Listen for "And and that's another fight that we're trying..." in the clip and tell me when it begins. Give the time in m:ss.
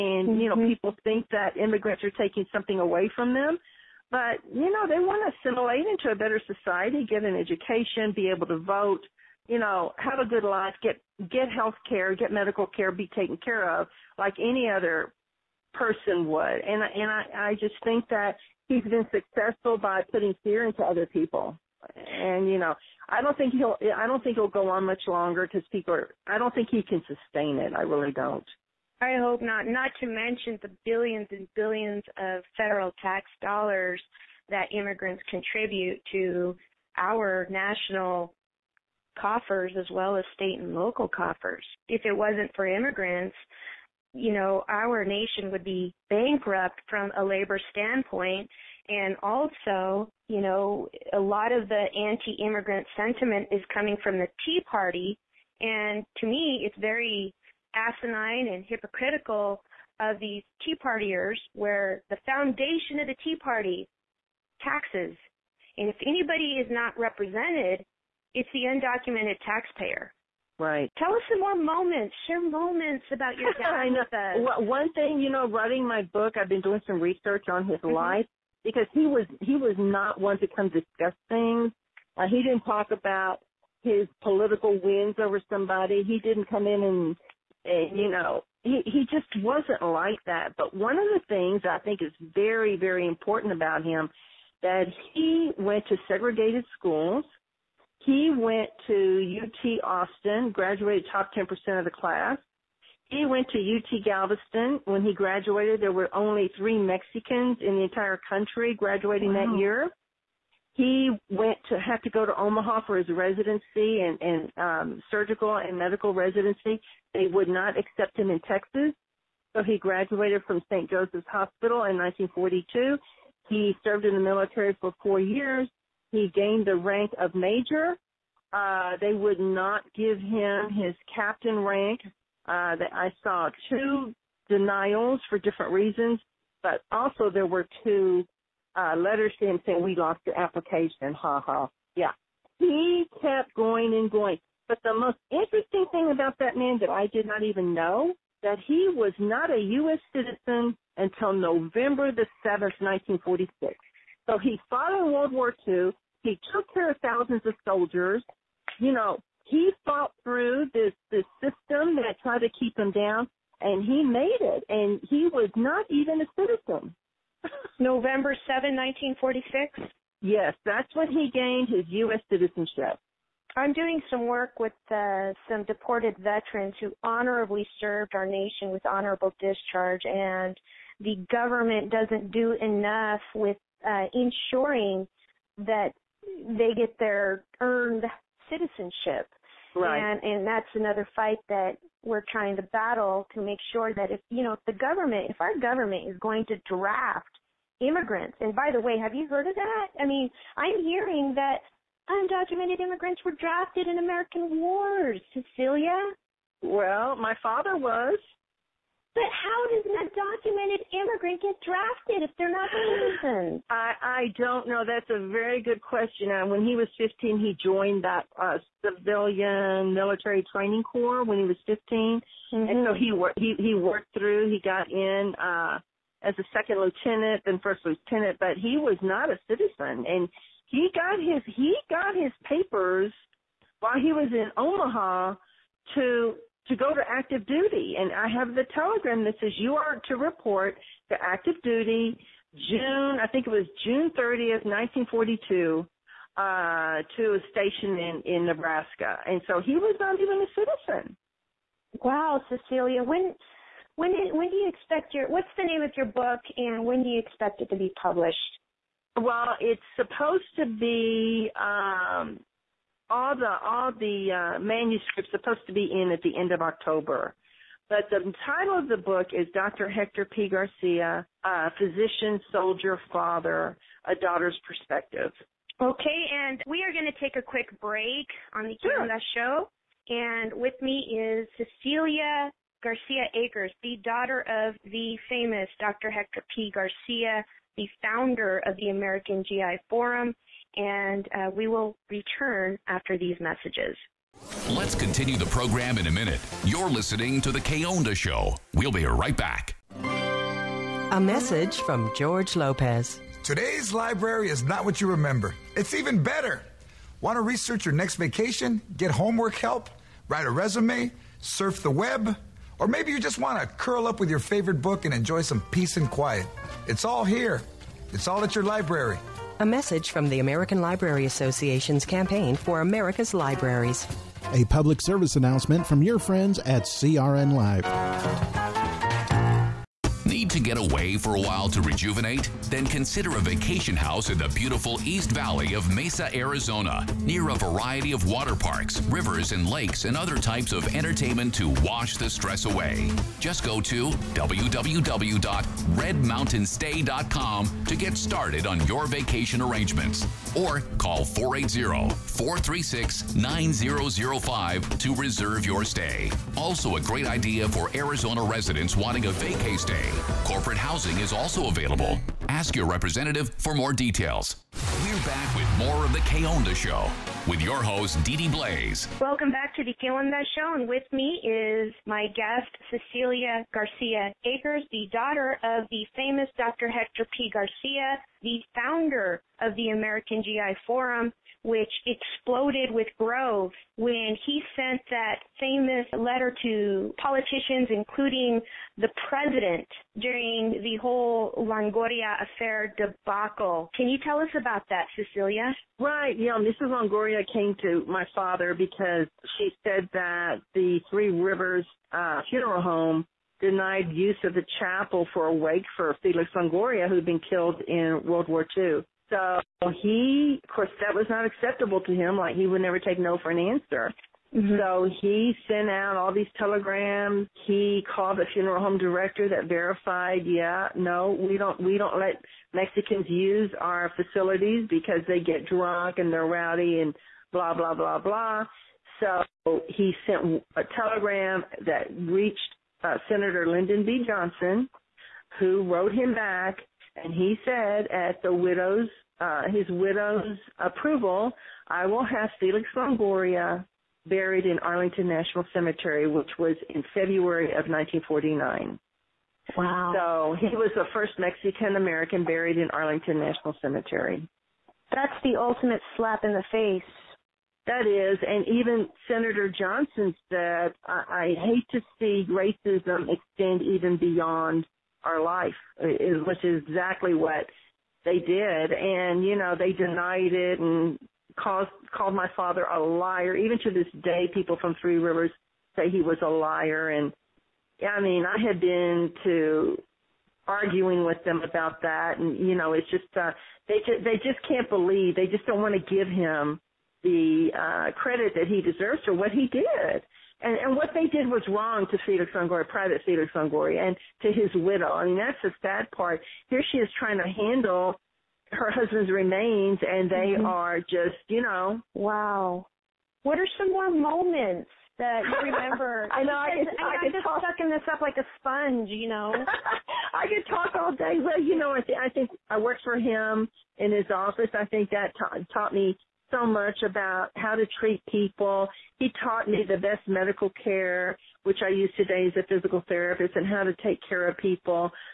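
3:09.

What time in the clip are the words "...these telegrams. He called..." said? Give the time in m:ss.
6:56.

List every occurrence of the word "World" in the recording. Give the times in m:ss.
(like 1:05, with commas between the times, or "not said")
2:35, 6:48.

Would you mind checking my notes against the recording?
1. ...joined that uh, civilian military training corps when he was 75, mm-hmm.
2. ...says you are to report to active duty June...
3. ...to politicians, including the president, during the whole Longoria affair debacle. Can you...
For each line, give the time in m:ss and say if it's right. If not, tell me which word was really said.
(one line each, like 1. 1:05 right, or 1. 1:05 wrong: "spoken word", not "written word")
1. 3:37 wrong: "15", not "75"
2. 3:59 right
3. 6:26 right.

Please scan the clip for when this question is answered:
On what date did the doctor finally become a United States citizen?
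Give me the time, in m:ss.
2:31.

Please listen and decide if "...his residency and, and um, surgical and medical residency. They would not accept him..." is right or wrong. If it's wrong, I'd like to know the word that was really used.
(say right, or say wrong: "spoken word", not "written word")
right.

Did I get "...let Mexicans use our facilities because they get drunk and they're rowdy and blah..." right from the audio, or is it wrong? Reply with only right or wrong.
right.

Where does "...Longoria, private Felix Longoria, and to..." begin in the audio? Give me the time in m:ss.
8:12.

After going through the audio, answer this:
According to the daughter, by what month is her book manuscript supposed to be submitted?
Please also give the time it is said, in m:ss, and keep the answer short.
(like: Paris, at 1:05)
end of October, at 4:26.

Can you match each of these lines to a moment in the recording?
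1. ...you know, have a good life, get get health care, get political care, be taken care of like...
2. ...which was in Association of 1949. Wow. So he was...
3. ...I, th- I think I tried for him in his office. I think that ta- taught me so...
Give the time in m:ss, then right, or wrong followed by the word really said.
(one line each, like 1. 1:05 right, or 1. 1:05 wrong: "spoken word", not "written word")
1. 0:09 wrong: "medical", not "political"
2. 7:26 wrong: "February", not "Association"
3. 8:31 wrong: "worked", not "tried".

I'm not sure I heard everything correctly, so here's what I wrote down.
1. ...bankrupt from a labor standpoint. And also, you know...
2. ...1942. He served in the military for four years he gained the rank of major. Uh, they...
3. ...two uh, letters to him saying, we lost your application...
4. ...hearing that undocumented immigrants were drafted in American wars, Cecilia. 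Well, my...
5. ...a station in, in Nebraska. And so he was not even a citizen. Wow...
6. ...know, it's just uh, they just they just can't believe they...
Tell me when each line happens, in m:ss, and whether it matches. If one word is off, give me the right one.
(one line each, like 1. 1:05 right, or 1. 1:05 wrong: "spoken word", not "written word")
1. 0:46 right
2. 2:01 right
3. 2:17 right
4. 3:20 right
5. 4:07 right
6. 8:02 right.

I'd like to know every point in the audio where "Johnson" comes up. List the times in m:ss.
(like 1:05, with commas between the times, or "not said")
7:14, 7:39.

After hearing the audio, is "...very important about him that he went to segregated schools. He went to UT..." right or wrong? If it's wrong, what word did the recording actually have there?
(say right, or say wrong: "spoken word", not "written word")
right.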